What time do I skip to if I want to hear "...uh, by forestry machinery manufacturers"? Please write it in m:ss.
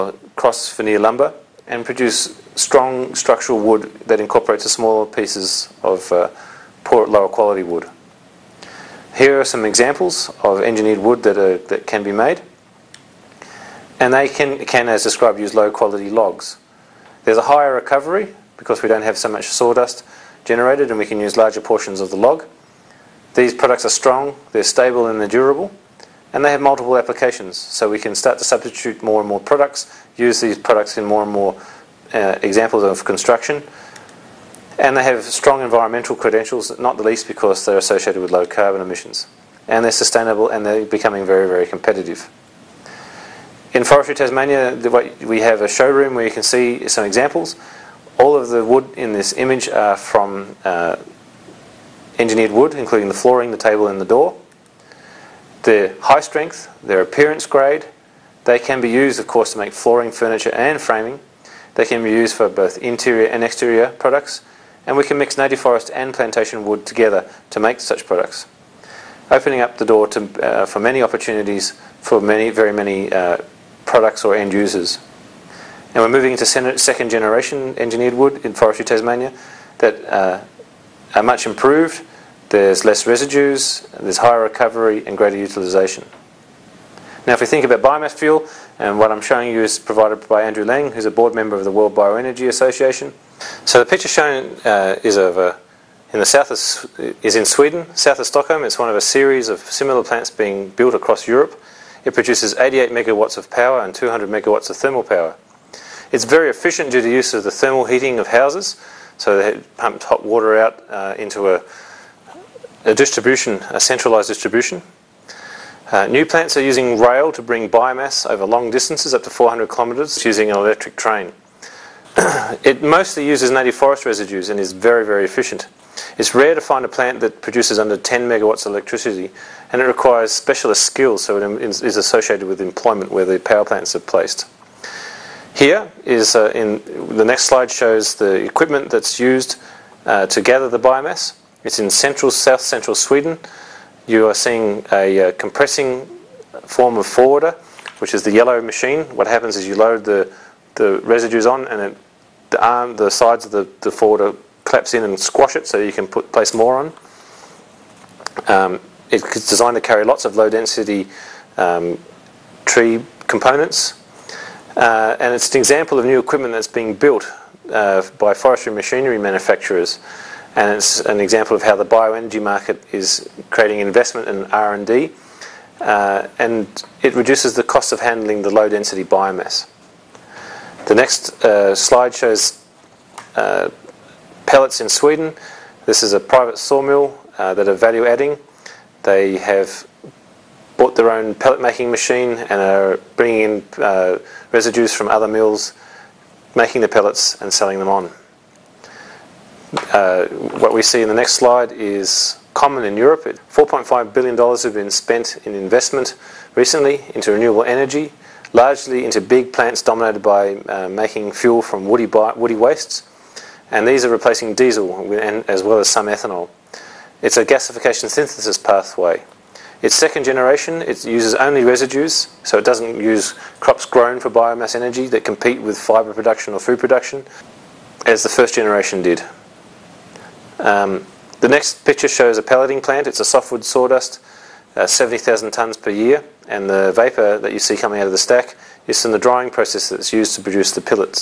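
2:47.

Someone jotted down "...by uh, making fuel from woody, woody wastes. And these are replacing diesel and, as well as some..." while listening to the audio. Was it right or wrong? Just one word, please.
right.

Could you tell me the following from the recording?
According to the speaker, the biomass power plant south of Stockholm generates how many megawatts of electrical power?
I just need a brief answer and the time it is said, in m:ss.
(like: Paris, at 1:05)
88 megawatts, at 1:42.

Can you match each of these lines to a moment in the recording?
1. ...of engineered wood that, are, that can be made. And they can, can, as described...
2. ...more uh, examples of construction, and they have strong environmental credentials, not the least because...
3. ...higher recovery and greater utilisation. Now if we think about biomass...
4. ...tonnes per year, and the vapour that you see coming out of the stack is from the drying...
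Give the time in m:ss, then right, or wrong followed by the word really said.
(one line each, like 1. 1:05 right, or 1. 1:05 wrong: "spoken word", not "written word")
1. 0:10 right
2. 0:31 right
3. 1:24 right
4. 3:55 right.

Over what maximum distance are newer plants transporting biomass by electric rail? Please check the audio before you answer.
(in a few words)
400 kilometres.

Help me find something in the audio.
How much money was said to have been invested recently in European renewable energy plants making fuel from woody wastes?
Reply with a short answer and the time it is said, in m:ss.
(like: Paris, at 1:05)
$4.5 billion, at 3:23.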